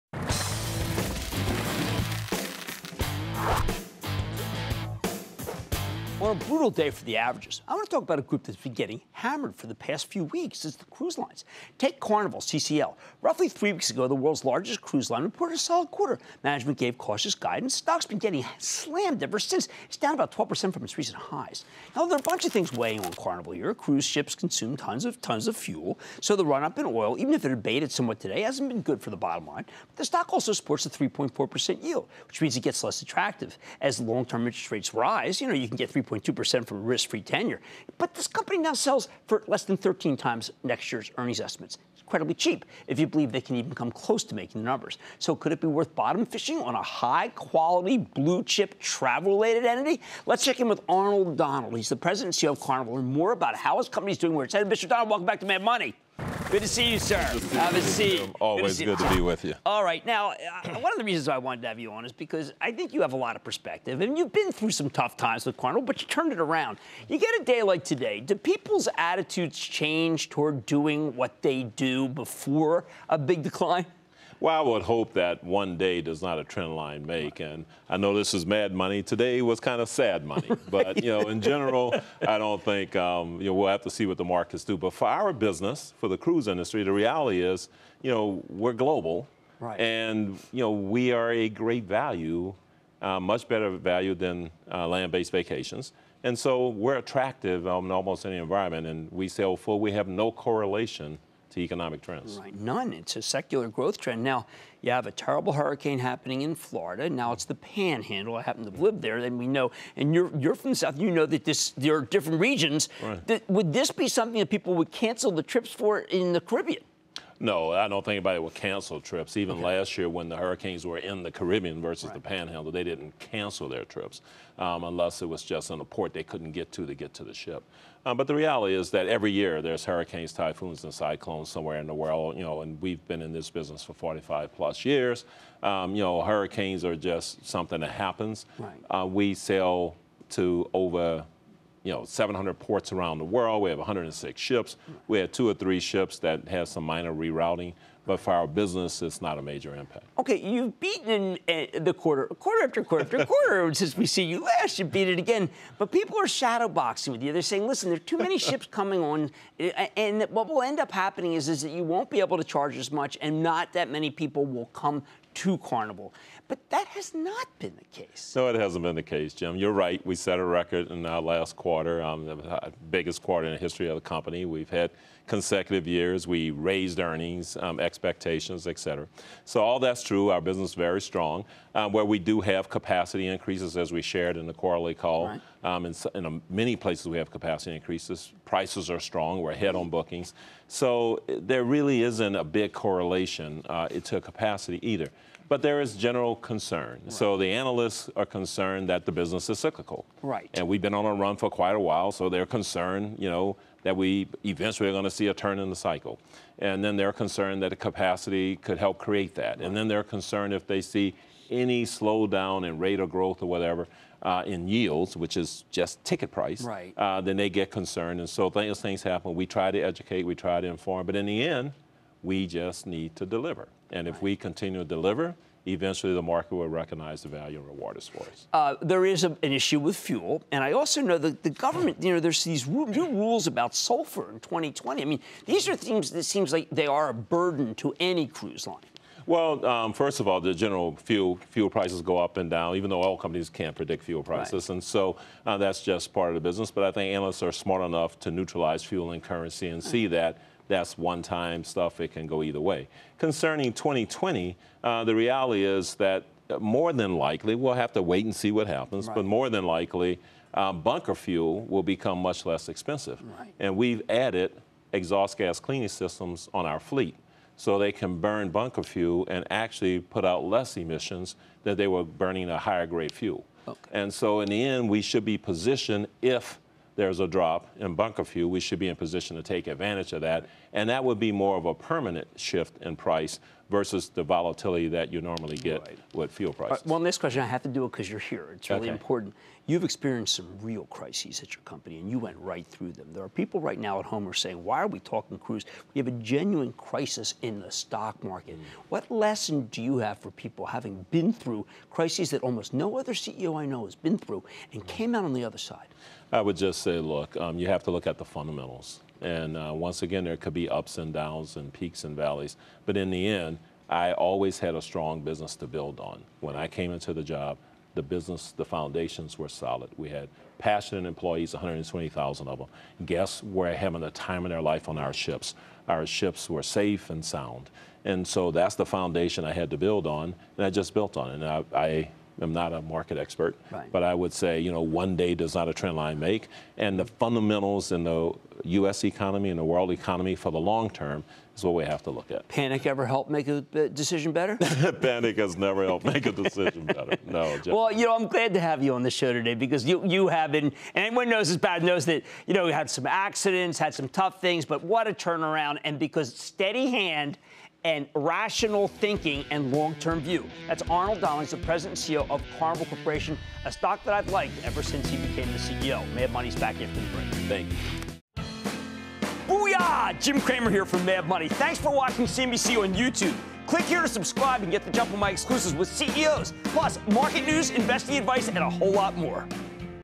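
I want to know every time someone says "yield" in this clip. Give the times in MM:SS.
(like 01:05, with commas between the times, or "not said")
00:31, 03:34.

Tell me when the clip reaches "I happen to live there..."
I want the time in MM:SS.
01:48.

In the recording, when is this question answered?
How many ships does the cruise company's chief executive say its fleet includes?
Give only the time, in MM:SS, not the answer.
02:23.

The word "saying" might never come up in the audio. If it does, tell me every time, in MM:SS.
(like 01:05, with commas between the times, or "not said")
02:37, 04:54.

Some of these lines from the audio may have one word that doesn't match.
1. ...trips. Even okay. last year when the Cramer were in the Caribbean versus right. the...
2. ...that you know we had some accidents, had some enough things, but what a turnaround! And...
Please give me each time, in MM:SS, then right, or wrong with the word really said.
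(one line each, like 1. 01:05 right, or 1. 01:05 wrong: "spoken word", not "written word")
1. 01:59 wrong: "Hurricanes", not "Cramer"
2. 05:52 wrong: "tough", not "enough".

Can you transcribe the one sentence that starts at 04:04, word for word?
and so uh, that's just part of the business.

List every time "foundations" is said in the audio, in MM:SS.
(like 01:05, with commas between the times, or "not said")
05:18, 05:28.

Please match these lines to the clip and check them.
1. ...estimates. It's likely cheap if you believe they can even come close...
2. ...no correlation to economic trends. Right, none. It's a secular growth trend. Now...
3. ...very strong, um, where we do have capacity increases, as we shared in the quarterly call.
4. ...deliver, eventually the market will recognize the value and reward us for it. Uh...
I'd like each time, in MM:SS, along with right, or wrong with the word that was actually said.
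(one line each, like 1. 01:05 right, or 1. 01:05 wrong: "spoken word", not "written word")
1. 00:41 wrong: "incredibly", not "likely"
2. 01:40 right
3. 03:00 right
4. 03:44 right.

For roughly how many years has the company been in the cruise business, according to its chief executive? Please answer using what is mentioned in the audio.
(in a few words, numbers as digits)
45 plus years.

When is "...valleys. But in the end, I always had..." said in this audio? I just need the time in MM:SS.
05:12.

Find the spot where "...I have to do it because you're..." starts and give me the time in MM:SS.
04:47.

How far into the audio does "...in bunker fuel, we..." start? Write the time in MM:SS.
04:37.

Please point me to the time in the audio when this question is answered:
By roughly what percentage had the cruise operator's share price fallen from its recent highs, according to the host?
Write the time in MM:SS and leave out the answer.
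00:20.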